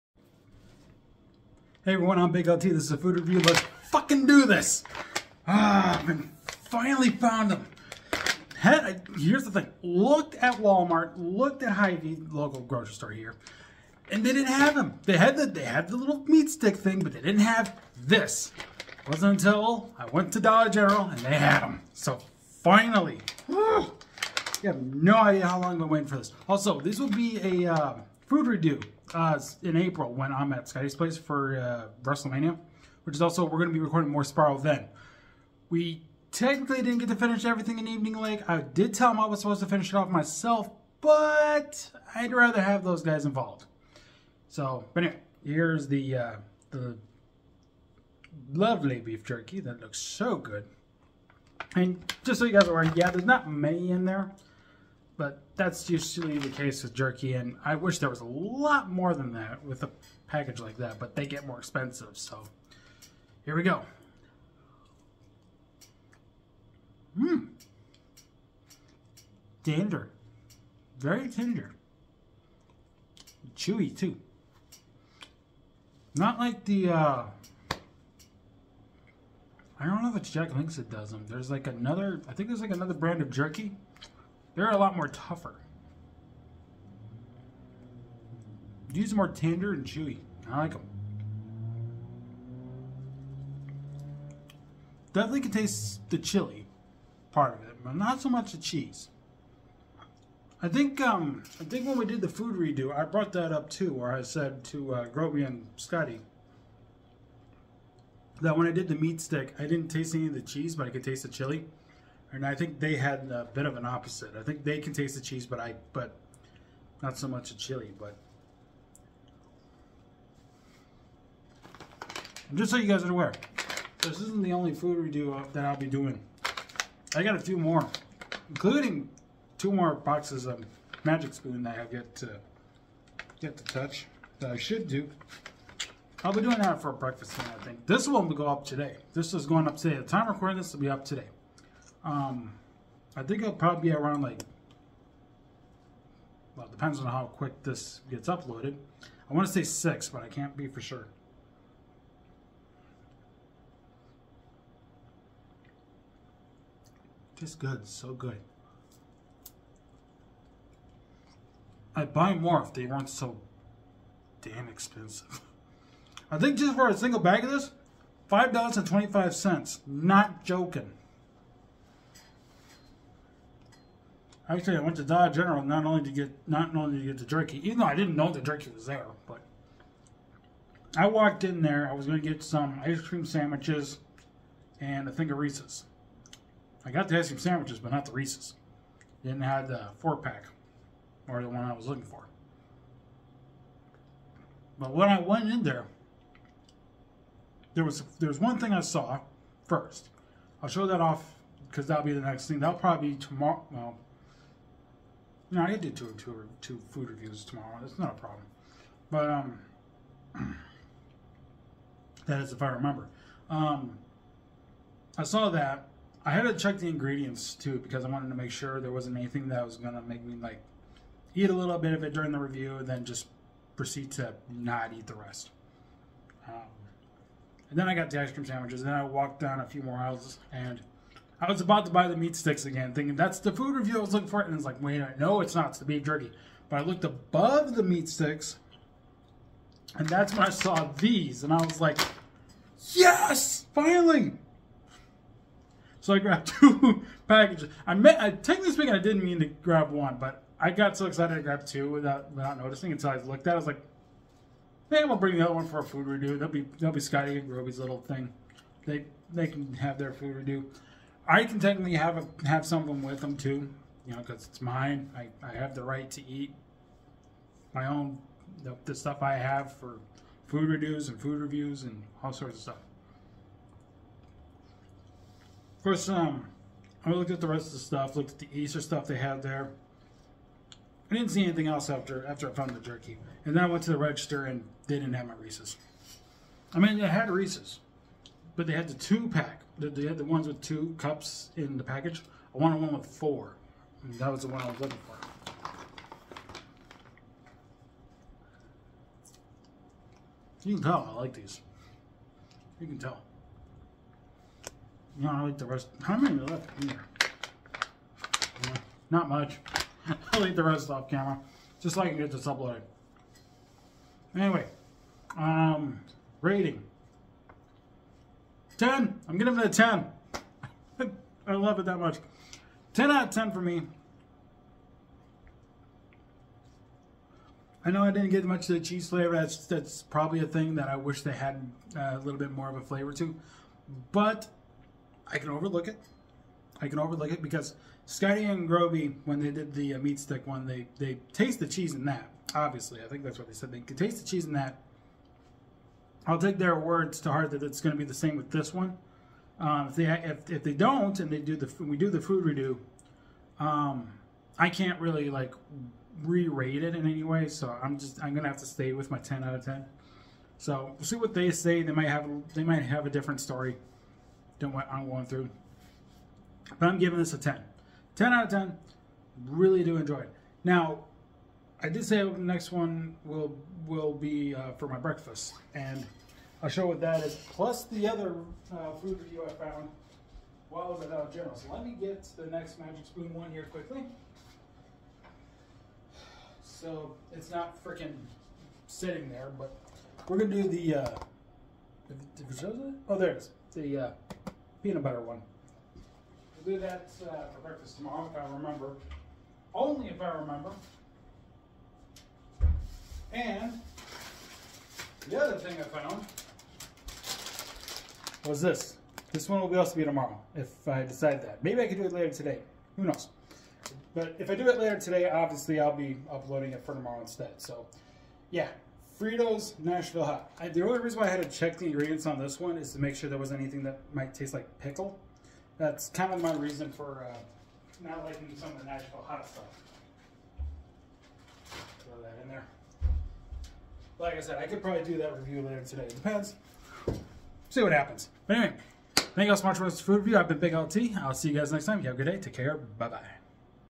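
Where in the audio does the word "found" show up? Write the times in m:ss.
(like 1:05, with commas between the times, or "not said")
0:07, 4:42, 6:19, 6:45.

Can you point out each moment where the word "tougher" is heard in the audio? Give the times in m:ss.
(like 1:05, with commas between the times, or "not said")
1:25.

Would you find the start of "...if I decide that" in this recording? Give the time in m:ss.
6:50.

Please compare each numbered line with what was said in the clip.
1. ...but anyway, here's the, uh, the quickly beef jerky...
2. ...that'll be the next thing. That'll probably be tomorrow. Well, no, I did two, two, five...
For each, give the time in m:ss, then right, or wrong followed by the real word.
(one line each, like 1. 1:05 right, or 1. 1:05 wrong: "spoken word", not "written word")
1. 0:44 wrong: "lovely", not "quickly"
2. 3:21 wrong: "two", not "five".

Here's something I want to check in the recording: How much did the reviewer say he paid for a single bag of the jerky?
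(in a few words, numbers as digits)
$5.25.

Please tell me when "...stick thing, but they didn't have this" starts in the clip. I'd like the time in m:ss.
0:16.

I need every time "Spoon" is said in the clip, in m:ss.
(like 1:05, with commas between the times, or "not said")
2:11, 6:23.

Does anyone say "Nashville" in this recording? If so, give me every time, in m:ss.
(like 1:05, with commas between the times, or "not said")
6:59, 7:08.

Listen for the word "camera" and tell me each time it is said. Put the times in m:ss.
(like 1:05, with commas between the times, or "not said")
5:11.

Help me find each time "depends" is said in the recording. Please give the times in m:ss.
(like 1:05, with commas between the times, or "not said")
2:26, 7:16.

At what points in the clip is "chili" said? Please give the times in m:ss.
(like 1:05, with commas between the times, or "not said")
1:36, 1:51, 1:57.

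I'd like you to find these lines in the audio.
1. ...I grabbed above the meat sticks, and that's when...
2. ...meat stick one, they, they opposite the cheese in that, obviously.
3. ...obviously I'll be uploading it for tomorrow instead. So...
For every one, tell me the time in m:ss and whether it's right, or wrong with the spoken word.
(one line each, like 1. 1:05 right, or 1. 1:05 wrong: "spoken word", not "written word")
1. 3:56 wrong: "looked", not "grabbed"
2. 5:39 wrong: "taste", not "opposite"
3. 6:55 right.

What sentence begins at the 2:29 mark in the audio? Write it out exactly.
I want to say six, but I can't be for sure.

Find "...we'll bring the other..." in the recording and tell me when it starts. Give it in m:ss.
4:15.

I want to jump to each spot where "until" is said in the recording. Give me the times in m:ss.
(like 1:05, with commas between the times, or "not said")
0:19, 4:12.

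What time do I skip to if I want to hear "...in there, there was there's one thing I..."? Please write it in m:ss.
3:15.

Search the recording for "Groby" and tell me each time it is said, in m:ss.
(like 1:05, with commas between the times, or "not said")
1:45, 4:17, 5:38.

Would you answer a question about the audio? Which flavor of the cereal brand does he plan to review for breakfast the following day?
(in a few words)
peanut butter.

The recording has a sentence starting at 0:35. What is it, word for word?
We technically didn't get to finish everything in Evening Lake.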